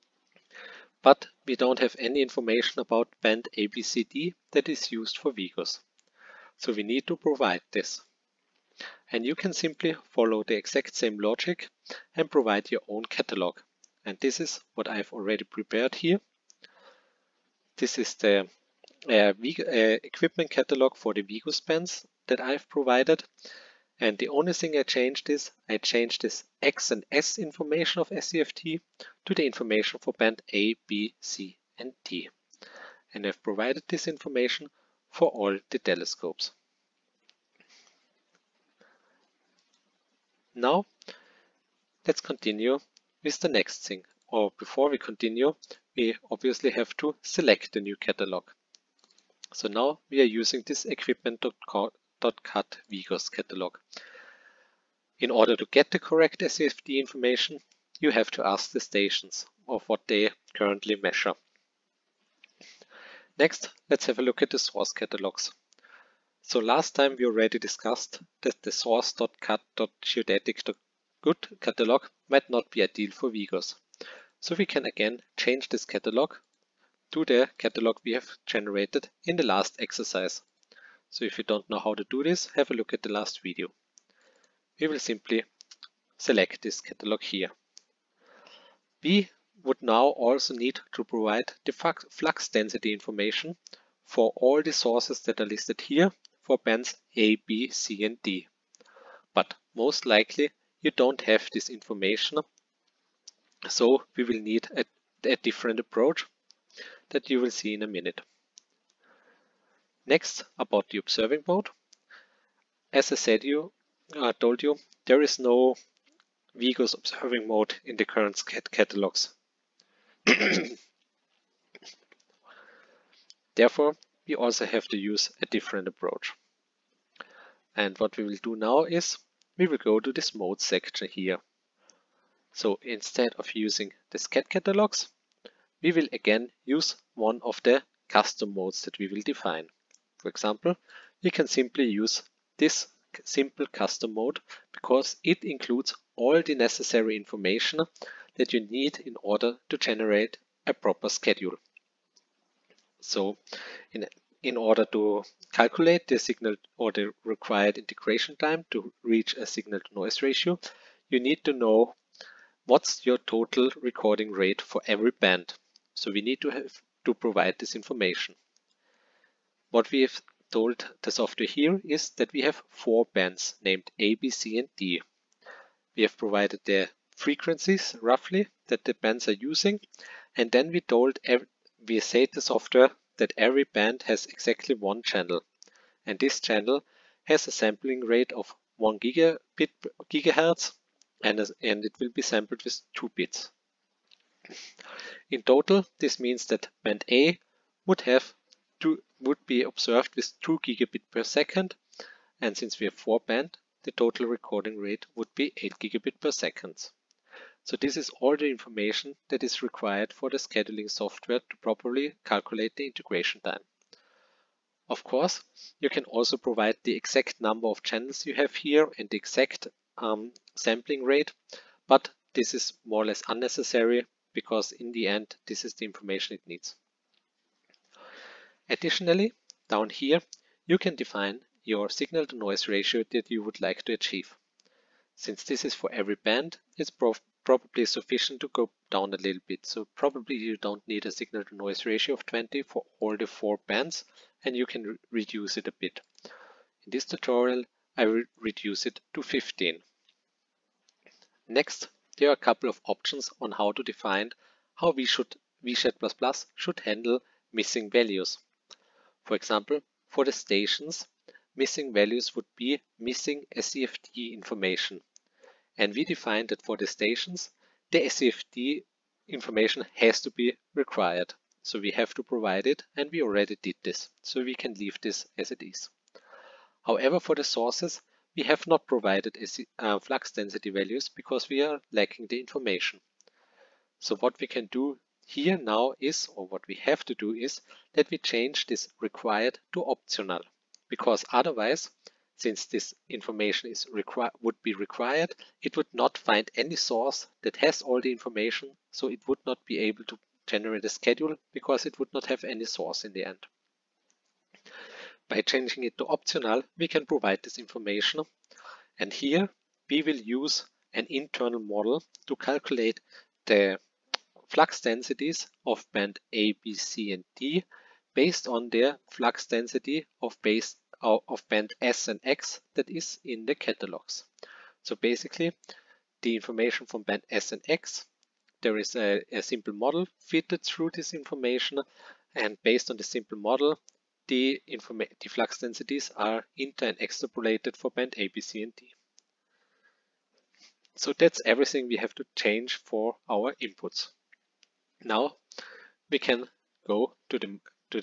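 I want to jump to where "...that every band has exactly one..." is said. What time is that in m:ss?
3:03.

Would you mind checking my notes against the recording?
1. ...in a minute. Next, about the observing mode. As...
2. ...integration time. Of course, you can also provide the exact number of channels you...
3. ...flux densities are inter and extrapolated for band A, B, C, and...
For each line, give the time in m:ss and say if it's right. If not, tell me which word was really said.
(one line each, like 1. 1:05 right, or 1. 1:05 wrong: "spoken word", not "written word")
1. 1:47 right
2. 3:32 right
3. 5:35 right.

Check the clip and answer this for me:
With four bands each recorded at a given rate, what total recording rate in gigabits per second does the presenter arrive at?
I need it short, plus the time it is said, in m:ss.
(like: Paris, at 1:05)
8 gigabit per second, at 3:25.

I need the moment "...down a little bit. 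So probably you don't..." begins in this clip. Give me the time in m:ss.
3:58.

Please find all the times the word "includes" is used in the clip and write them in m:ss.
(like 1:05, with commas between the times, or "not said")
2:25.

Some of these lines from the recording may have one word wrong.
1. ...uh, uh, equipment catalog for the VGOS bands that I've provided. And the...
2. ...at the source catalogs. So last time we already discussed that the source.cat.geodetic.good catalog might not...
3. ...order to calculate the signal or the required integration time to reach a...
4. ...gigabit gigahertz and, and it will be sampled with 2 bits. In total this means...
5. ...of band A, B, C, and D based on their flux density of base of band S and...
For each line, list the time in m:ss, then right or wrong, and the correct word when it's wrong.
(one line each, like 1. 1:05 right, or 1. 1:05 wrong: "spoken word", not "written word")
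1. 0:19 right
2. 1:04 right
3. 2:34 right
4. 3:09 right
5. 5:15 right.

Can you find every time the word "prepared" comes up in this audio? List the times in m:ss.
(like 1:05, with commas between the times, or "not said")
0:15.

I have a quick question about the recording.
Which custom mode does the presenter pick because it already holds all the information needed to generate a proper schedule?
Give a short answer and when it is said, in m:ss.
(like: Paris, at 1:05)
simple custom mode, at 2:23.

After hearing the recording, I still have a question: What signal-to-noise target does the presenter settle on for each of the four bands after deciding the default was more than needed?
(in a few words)
15.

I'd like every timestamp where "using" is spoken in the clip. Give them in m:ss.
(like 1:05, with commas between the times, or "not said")
0:50, 2:13, 2:59.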